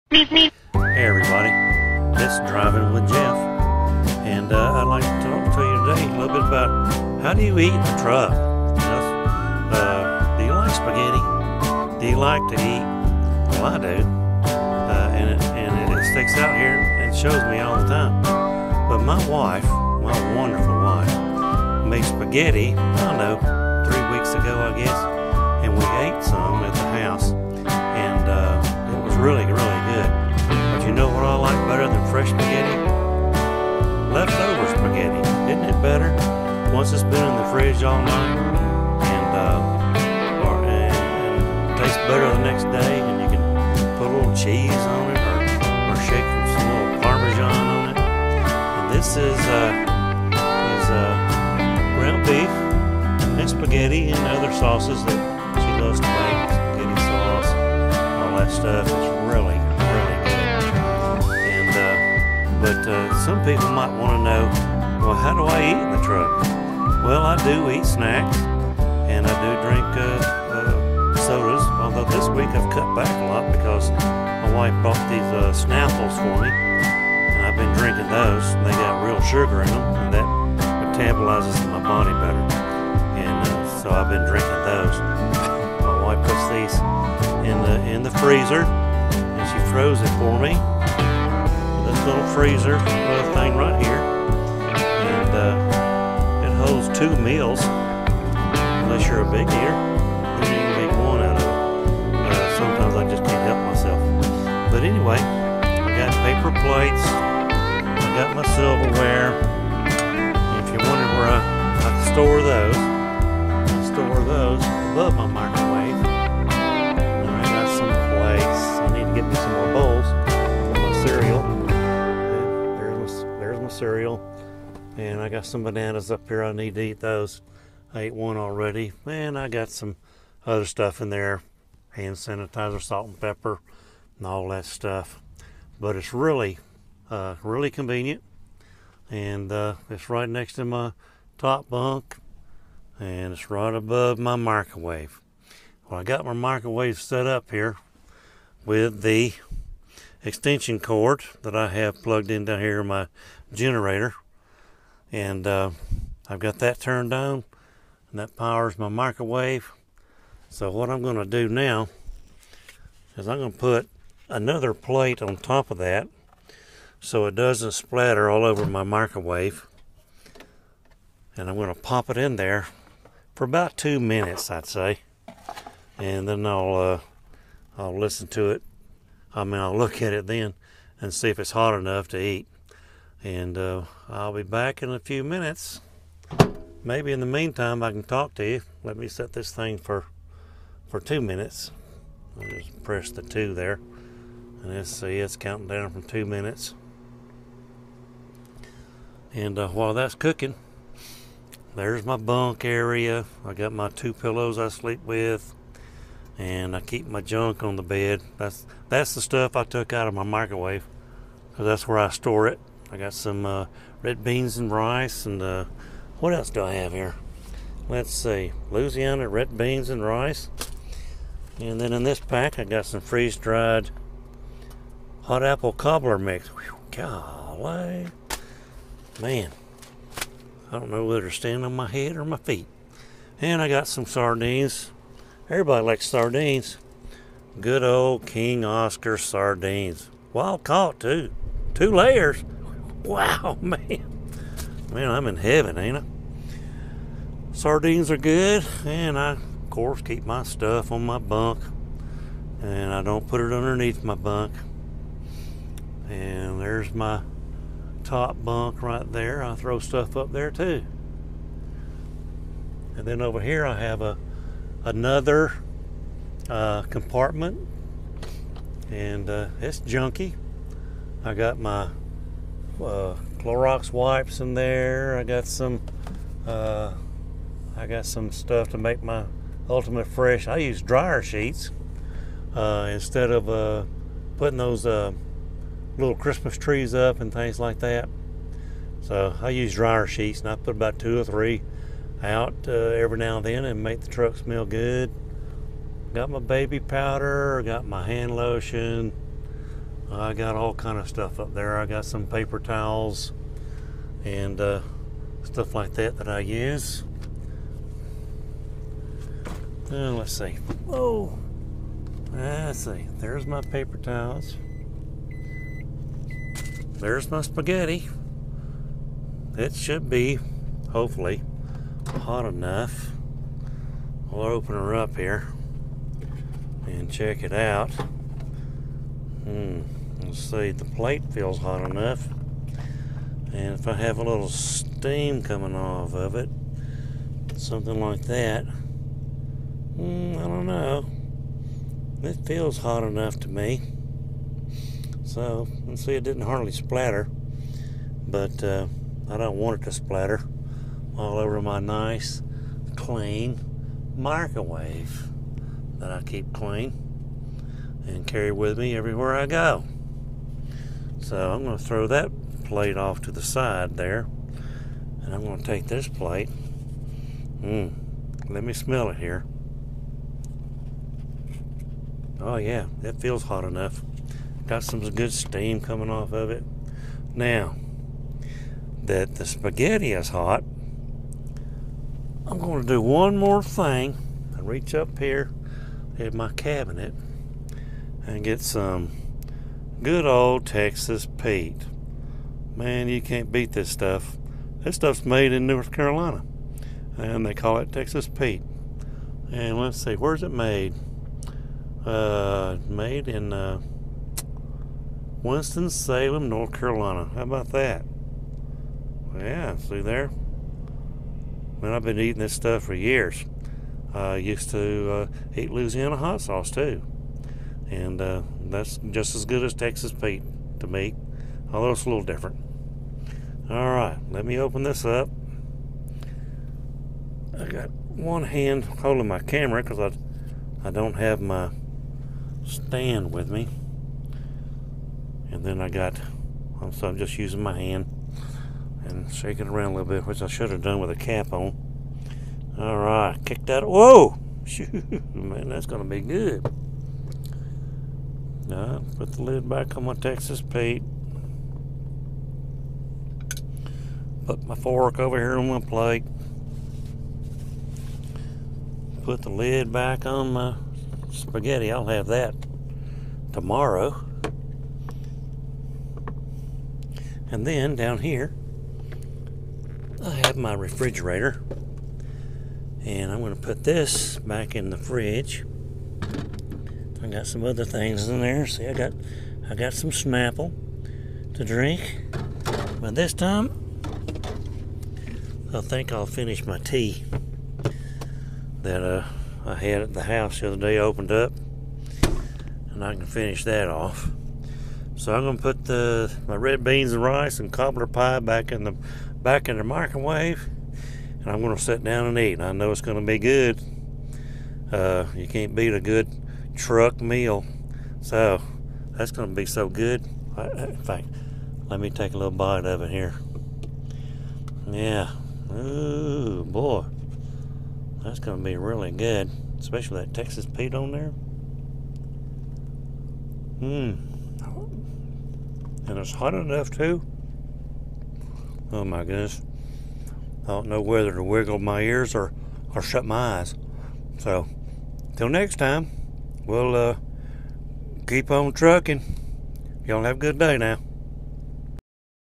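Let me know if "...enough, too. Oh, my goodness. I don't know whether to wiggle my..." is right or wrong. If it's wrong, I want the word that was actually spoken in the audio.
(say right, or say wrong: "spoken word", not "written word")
right.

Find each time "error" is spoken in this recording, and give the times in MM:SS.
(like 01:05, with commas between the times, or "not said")
not said.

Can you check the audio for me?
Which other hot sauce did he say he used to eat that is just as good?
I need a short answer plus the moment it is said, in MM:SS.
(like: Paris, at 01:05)
Louisiana hot sauce, at 06:55.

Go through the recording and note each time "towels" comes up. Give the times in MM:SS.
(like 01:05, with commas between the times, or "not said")
05:02, 05:13.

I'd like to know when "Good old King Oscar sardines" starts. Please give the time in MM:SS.
03:57.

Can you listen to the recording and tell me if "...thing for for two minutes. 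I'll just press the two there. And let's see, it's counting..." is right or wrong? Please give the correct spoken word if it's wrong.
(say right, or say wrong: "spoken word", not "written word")
right.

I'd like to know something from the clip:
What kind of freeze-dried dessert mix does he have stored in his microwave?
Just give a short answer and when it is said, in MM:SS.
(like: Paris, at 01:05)
Hot apple cobbler, at 03:45.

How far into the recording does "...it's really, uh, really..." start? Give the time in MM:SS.
02:15.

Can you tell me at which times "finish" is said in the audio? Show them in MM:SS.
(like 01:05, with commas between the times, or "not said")
08:06, 08:13.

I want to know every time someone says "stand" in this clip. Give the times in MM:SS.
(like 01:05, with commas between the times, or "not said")
03:51, 07:12.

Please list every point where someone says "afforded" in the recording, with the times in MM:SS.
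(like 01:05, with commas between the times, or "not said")
not said.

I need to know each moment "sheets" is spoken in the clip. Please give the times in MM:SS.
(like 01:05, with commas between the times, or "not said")
04:41, 04:50.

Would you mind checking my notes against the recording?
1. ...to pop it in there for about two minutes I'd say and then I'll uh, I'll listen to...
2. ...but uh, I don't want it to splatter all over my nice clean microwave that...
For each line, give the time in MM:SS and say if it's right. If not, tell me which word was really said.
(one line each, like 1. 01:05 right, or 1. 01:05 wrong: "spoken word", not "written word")
1. 02:51 right
2. 05:48 right.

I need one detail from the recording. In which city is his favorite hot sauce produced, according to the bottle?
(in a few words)
Winston Salem.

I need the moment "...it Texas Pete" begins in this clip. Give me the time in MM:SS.
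06:37.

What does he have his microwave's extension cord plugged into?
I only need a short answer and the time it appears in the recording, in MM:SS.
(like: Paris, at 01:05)
Generator, at 02:33.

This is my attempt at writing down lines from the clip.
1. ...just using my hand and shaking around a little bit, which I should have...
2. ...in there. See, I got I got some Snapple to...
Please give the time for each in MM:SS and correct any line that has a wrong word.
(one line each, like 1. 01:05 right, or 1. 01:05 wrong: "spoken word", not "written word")
1. 07:17 right
2. 07:58 right.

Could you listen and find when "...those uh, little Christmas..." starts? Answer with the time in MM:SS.
04:44.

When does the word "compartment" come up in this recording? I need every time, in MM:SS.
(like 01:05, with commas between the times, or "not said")
04:26.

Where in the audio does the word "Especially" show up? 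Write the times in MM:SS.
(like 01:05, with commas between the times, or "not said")
08:39.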